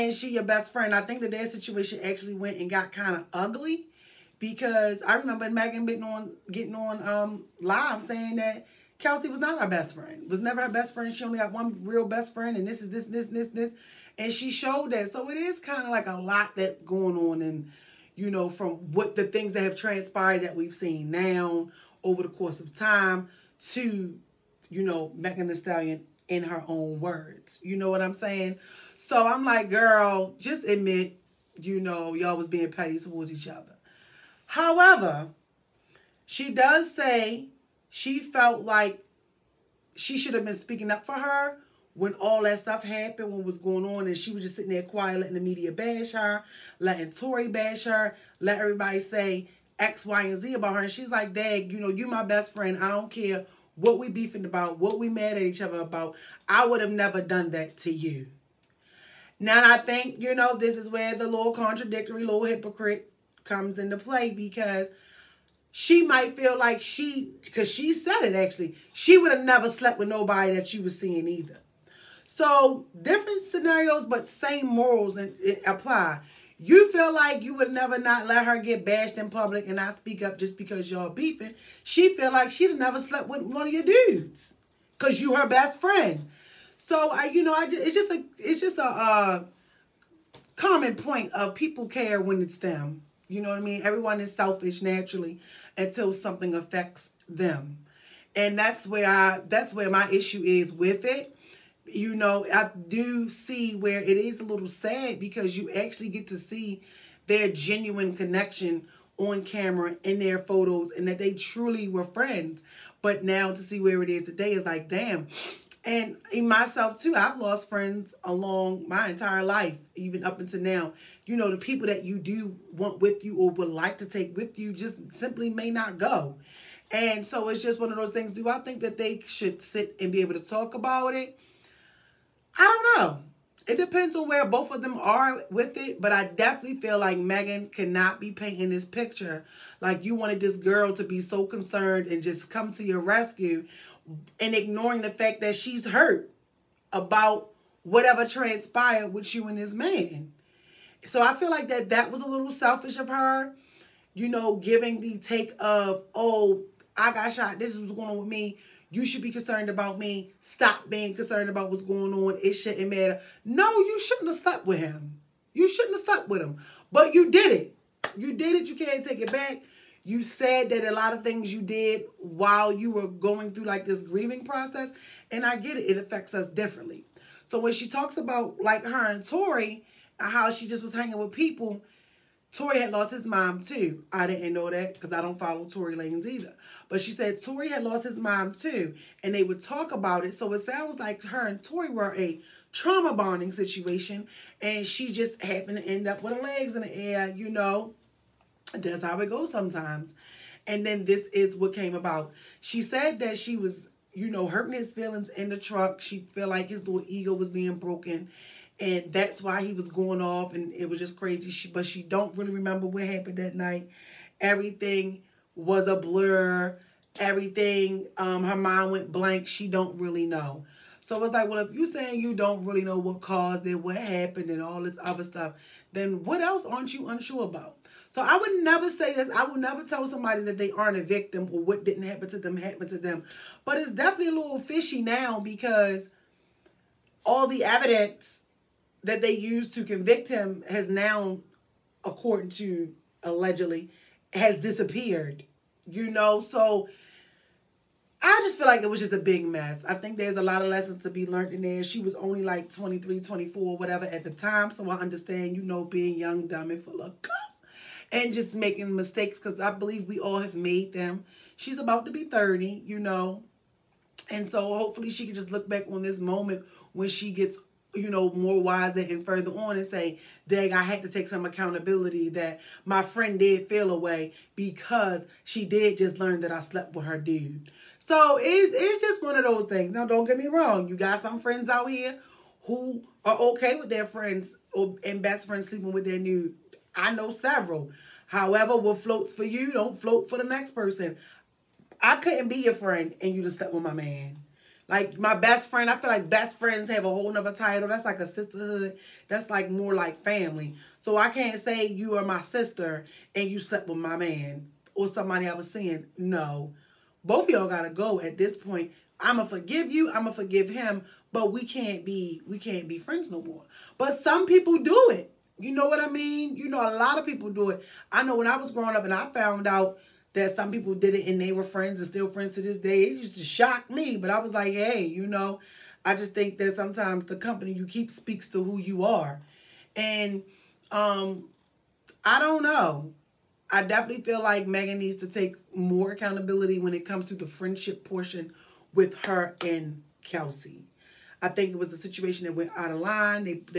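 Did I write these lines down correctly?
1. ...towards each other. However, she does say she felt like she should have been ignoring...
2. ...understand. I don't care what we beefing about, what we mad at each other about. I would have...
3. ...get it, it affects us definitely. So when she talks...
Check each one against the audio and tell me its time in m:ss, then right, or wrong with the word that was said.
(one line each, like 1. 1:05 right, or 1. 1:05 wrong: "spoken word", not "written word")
1. 0:32 wrong: "speaking", not "ignoring"
2. 0:52 wrong: "friend", not "understand"
3. 2:55 wrong: "differently", not "definitely".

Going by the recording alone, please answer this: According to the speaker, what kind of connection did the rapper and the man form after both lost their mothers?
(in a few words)
Trauma bonding.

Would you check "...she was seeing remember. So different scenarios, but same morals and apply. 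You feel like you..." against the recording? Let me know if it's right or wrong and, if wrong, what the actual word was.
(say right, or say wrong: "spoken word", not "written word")
wrong: "either", not "remember".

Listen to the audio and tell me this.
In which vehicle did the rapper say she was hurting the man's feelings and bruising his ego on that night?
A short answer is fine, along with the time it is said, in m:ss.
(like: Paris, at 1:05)
The truck, at 3:25.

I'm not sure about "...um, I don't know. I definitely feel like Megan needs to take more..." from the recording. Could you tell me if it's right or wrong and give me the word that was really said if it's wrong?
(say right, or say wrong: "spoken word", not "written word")
right.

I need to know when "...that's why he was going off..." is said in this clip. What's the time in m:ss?
3:29.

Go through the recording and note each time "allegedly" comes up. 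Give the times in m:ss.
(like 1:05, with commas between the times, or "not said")
4:03.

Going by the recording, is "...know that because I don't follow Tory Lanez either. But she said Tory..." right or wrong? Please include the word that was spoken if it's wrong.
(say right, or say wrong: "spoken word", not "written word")
right.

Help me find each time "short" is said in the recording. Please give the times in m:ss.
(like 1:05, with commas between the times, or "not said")
not said.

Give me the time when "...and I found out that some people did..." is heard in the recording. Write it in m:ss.
5:19.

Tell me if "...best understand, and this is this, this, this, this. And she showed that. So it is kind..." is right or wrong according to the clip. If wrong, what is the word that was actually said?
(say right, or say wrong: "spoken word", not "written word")
wrong: "friend", not "understand".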